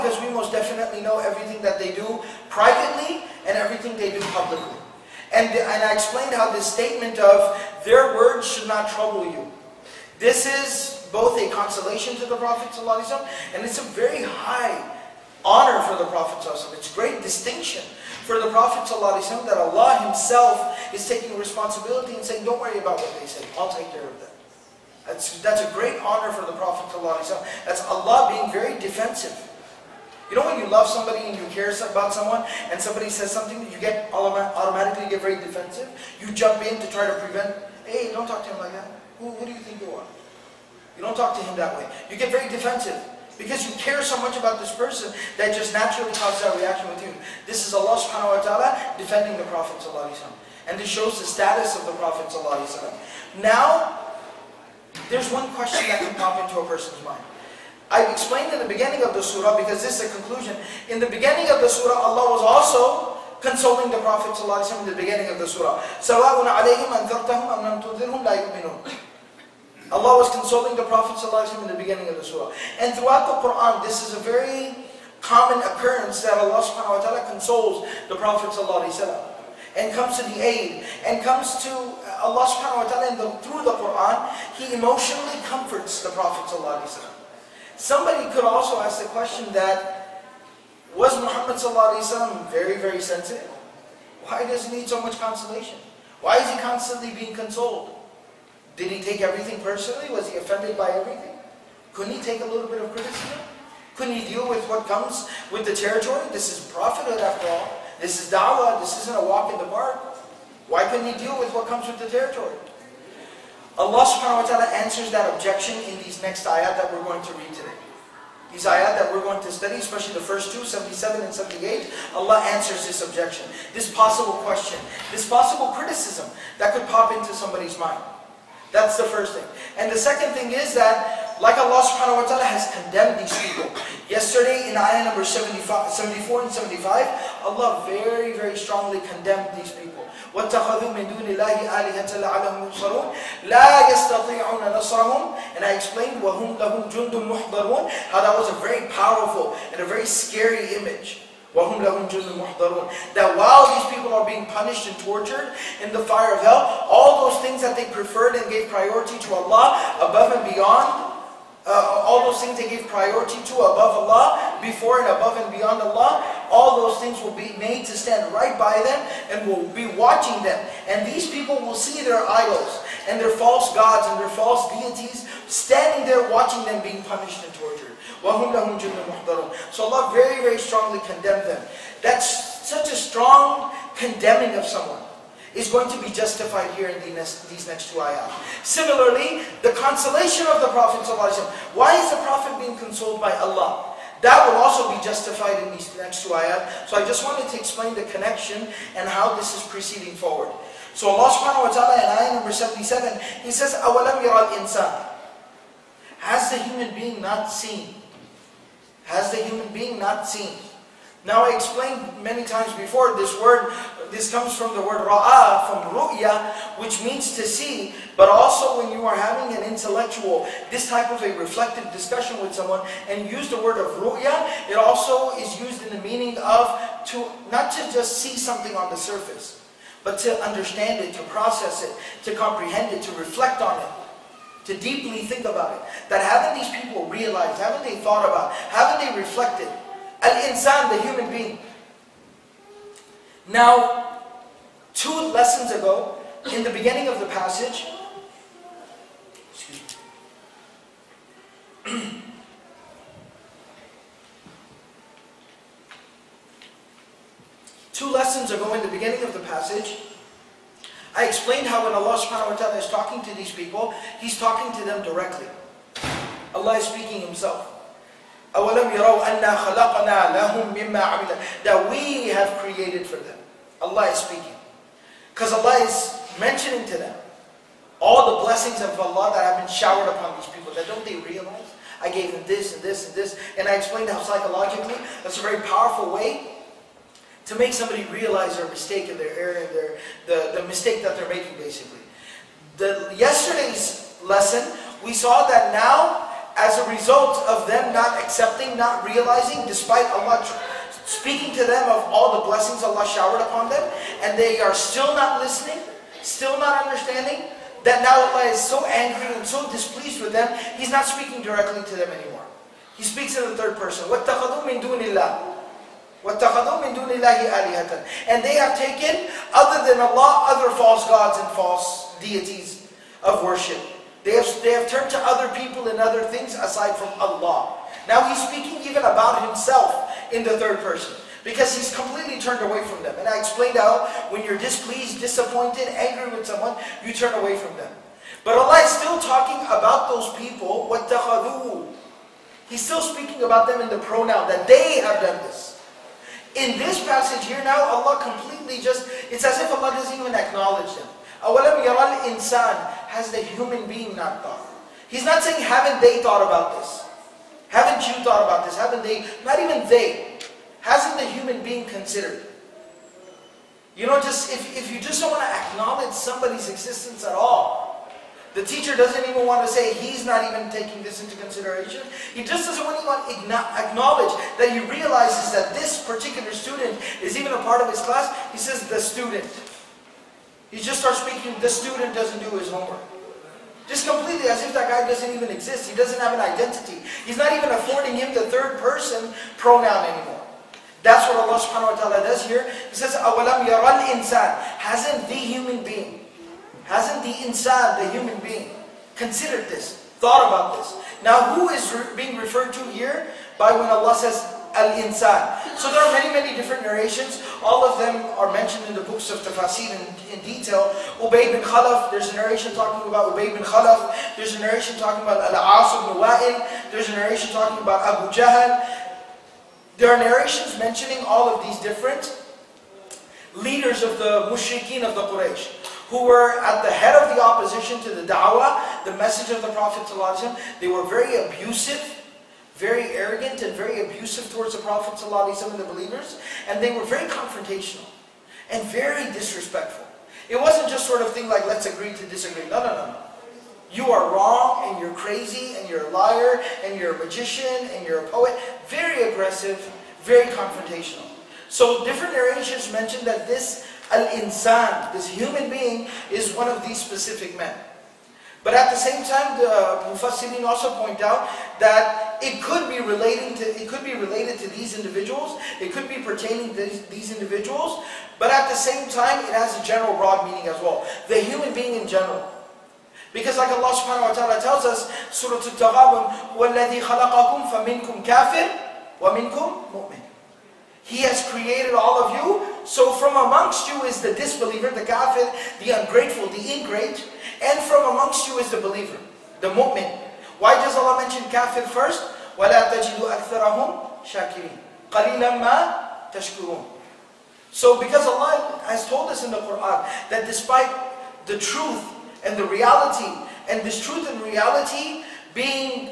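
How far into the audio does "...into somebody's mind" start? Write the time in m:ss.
2:07.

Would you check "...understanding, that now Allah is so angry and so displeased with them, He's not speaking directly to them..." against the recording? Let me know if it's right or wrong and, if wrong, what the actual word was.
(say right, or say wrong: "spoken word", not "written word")
right.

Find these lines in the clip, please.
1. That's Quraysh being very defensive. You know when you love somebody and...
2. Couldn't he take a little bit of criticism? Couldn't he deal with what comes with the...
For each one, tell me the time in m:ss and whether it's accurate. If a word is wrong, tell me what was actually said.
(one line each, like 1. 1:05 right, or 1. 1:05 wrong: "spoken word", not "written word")
1. 0:27 wrong: "Allah", not "Quraysh"
2. 1:41 right.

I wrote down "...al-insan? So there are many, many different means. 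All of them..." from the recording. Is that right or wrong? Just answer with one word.
wrong.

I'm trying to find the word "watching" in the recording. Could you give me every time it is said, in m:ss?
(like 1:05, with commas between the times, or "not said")
2:49, 2:56.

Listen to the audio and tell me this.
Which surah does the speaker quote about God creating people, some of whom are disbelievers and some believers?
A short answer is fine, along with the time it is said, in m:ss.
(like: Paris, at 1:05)
Surah Al-Taghabun, at 7:55.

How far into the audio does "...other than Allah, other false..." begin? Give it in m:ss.
5:19.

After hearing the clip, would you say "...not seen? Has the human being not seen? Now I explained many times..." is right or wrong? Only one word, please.
right.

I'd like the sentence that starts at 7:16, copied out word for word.
And they were very confrontational and very disrespectful.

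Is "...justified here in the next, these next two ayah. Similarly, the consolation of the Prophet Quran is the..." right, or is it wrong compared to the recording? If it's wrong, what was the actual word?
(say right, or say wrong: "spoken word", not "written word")
wrong: "Why", not "Quran".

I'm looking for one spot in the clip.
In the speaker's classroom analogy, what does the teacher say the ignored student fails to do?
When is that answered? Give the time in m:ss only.
6:22.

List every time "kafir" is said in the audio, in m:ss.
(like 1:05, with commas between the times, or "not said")
8:05, 8:11.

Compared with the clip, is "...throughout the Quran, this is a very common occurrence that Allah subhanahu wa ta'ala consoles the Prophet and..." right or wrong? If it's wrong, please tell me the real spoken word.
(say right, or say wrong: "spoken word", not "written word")
right.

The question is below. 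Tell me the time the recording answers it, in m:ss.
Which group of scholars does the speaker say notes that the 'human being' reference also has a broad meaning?
7:40.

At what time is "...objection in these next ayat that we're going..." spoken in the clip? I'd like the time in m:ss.
1:55.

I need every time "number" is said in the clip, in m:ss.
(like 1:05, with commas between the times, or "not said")
2:15, 3:22.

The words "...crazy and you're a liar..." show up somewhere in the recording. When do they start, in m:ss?
7:25.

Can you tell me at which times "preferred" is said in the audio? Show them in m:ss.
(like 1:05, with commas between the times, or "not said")
2:37.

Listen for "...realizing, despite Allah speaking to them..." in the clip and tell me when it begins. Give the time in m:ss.
4:59.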